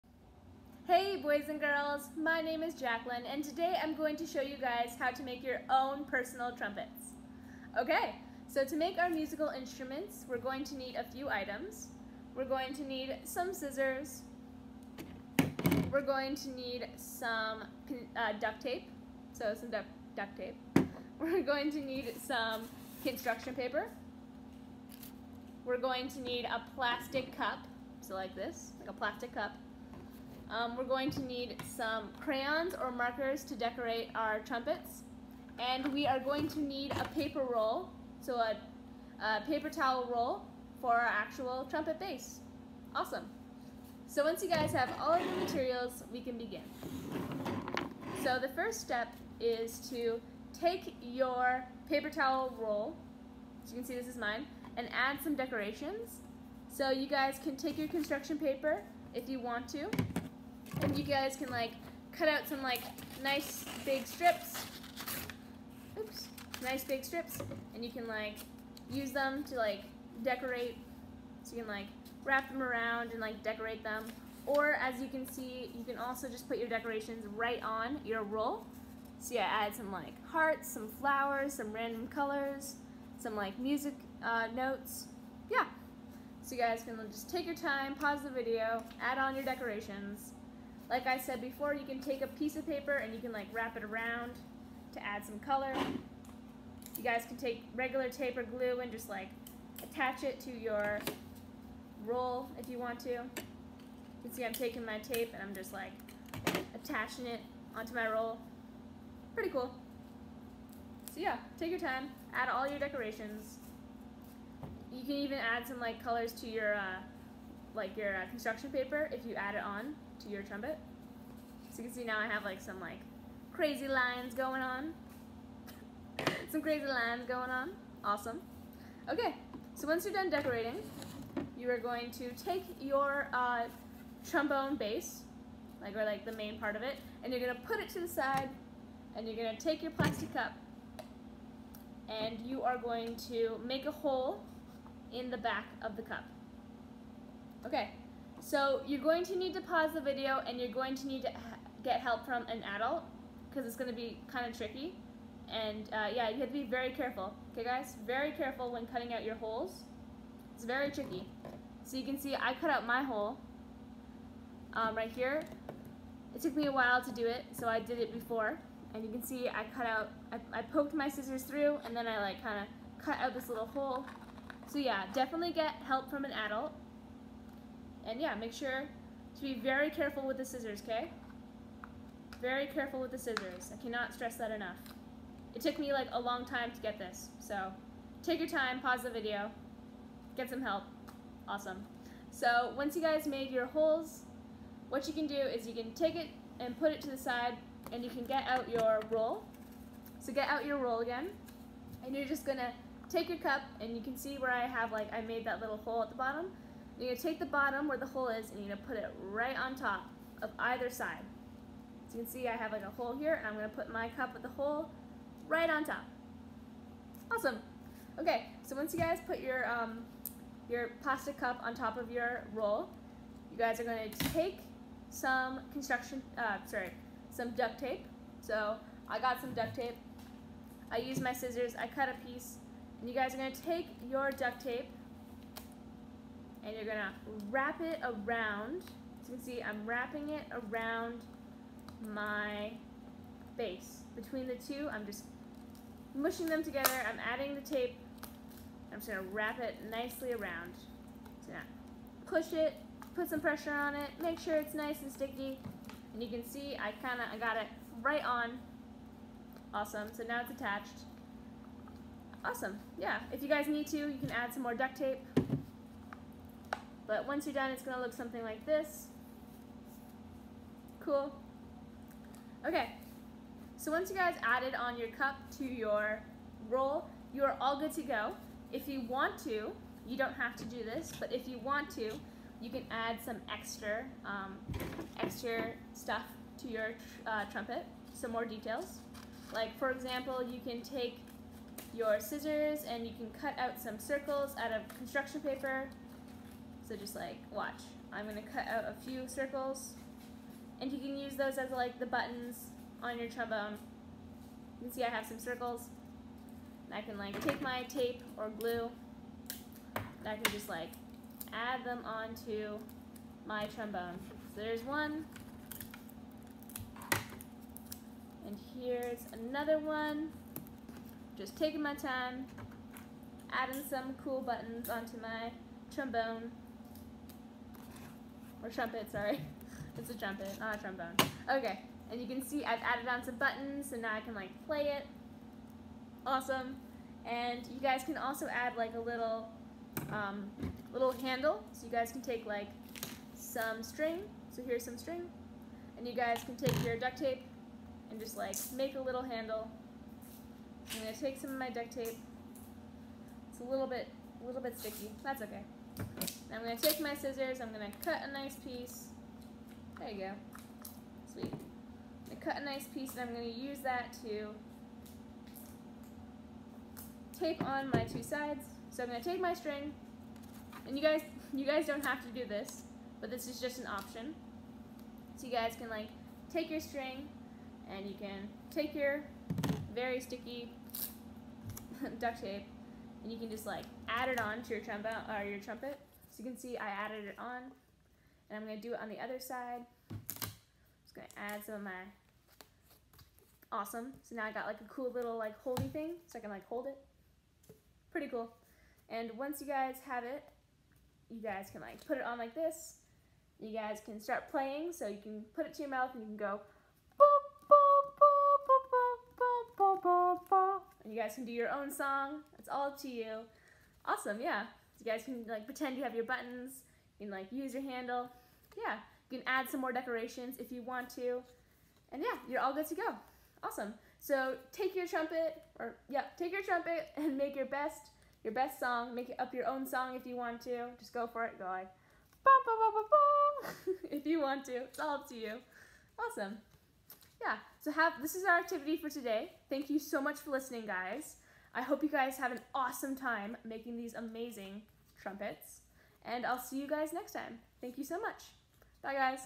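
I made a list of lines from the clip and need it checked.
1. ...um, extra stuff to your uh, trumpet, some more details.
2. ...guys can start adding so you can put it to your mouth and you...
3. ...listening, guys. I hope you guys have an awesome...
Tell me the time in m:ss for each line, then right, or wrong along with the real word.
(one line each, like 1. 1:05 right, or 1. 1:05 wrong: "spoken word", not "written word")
1. 4:44 right
2. 6:43 wrong: "playing", not "adding"
3. 7:20 right.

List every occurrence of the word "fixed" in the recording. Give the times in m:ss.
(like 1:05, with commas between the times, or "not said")
not said.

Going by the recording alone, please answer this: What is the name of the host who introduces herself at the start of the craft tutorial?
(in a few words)
Jaclyn.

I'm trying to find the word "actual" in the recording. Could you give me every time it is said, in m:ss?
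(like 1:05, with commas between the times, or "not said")
0:41.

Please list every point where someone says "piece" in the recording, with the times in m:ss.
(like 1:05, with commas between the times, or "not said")
1:32, 3:52, 5:58, 6:02.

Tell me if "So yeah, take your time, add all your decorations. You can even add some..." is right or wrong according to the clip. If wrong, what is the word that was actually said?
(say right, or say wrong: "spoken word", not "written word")
right.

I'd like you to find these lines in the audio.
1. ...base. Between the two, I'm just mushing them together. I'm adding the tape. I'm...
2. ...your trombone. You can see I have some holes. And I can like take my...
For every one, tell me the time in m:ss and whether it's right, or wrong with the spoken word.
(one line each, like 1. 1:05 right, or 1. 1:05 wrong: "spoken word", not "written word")
1. 4:03 right
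2. 5:03 wrong: "circles", not "holes".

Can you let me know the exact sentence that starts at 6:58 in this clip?
Yeah, you can add some more decorations if you want to.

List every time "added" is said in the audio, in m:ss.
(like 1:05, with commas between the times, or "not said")
4:34, 5:32, 6:26.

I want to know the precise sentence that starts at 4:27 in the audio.
But once you're done, it's gonna look something like this.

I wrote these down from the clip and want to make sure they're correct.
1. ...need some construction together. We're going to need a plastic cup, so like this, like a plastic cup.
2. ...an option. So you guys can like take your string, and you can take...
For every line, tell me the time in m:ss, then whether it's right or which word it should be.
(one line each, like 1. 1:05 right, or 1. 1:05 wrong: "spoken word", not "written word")
1. 0:21 wrong: "paper", not "together"
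2. 6:13 right.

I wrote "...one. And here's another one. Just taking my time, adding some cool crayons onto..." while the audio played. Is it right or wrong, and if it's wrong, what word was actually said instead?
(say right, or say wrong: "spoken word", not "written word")
wrong: "buttons", not "crayons".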